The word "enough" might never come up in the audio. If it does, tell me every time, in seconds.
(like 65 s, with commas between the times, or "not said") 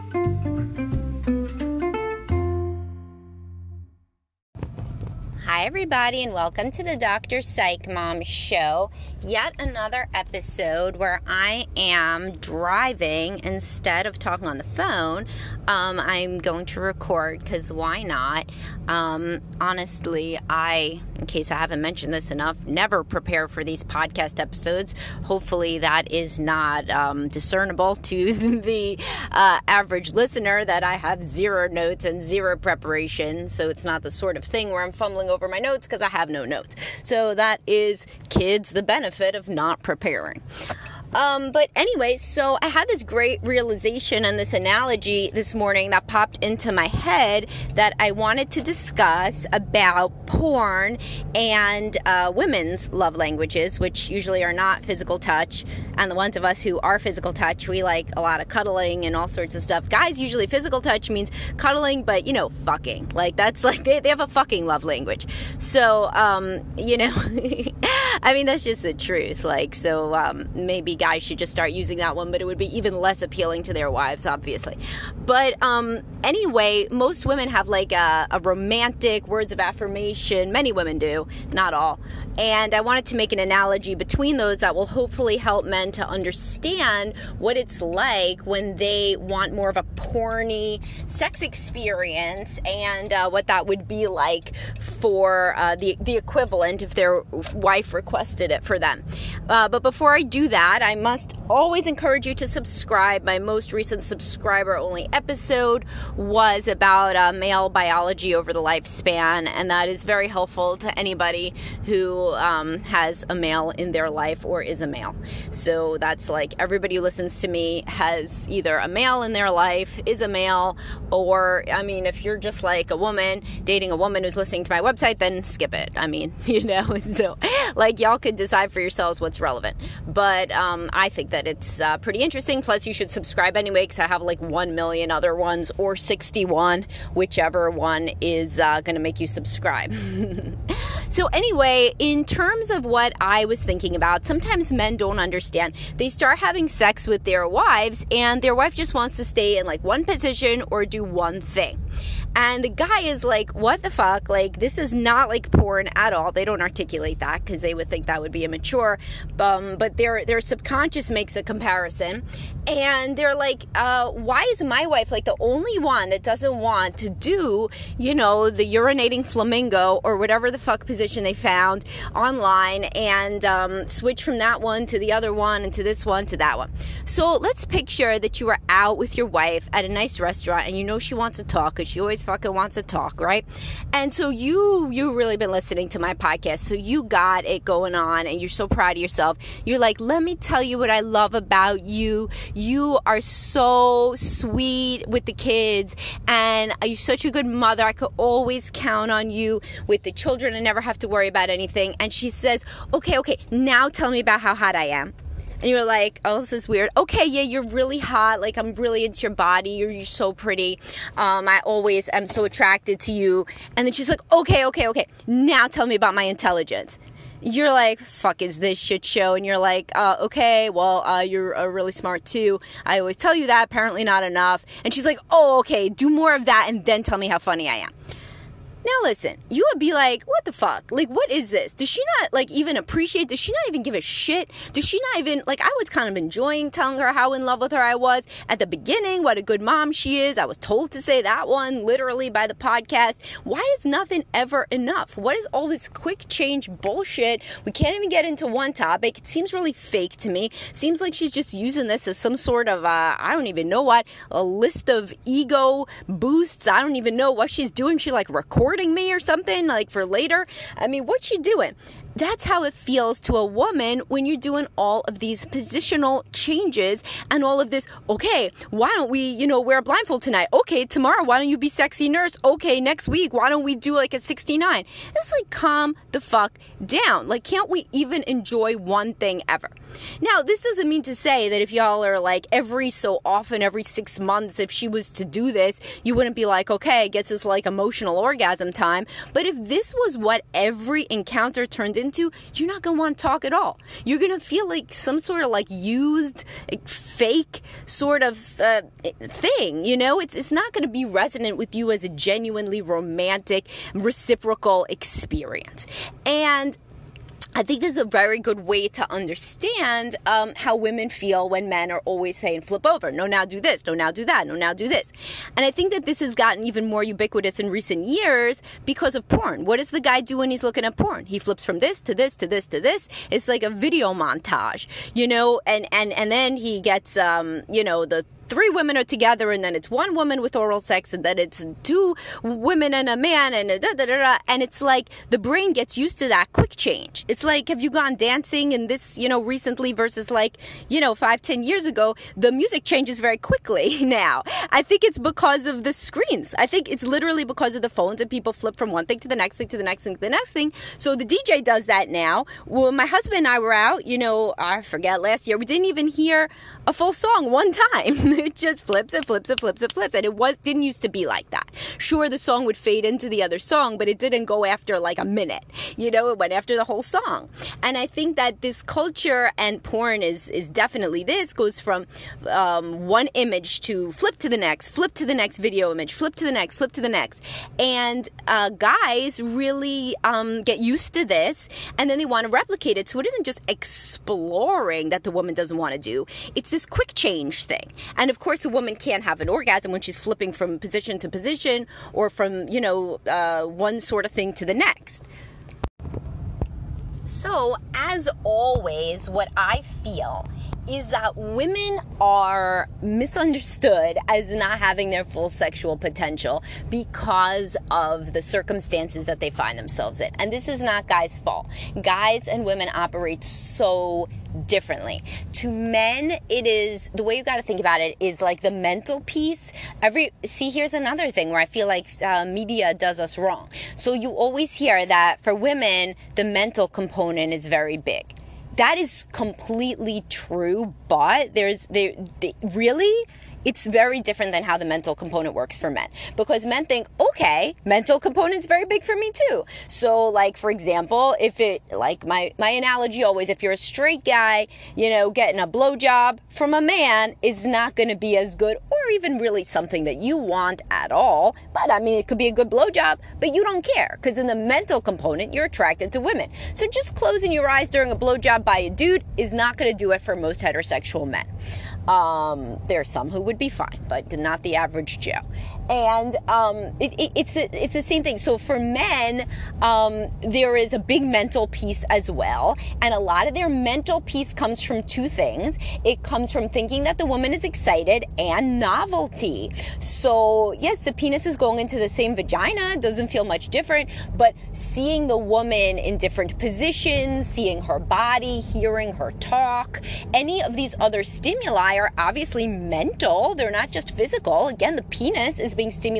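22 s, 224 s, 244 s.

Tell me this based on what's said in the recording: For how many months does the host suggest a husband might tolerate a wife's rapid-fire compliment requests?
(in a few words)
6.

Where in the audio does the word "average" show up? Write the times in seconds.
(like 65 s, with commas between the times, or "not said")
29 s, 464 s.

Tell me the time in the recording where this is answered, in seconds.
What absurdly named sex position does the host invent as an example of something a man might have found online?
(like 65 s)
168 s.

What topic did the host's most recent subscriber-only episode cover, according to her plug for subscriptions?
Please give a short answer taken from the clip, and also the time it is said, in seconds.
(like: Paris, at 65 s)
male biology over the lifespan, at 107 s.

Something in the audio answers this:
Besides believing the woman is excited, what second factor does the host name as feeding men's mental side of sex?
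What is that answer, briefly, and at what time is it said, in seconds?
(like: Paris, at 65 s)
novelty, at 478 s.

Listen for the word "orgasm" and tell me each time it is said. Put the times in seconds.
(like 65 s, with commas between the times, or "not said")
288 s, 389 s.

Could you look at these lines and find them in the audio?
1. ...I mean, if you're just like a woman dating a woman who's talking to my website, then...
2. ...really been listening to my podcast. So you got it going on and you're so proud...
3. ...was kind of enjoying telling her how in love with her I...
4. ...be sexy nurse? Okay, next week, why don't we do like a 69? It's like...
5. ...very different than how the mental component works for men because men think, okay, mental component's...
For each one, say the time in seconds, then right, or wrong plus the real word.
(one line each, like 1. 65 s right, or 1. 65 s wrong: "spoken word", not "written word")
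1. 121 s wrong: "listening", not "talking"
2. 185 s right
3. 235 s right
4. 271 s right
5. 433 s right.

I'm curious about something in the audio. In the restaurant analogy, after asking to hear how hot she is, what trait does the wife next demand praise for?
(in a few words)
intelligence.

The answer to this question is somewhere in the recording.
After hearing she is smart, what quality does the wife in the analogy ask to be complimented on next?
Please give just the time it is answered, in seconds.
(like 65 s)
227 s.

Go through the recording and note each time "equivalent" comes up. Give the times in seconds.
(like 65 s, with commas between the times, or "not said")
96 s.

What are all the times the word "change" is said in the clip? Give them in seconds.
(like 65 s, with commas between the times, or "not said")
246 s, 266 s, 336 s, 342 s, 387 s.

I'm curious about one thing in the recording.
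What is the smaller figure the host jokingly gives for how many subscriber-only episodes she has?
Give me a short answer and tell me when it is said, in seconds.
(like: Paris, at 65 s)
61, at 135 s.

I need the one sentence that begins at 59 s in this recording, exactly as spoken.
Guys, usually physical touch means cuddling, but you know, fucking.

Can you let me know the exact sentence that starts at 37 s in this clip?
So that is, kids, the benefit of not preparing.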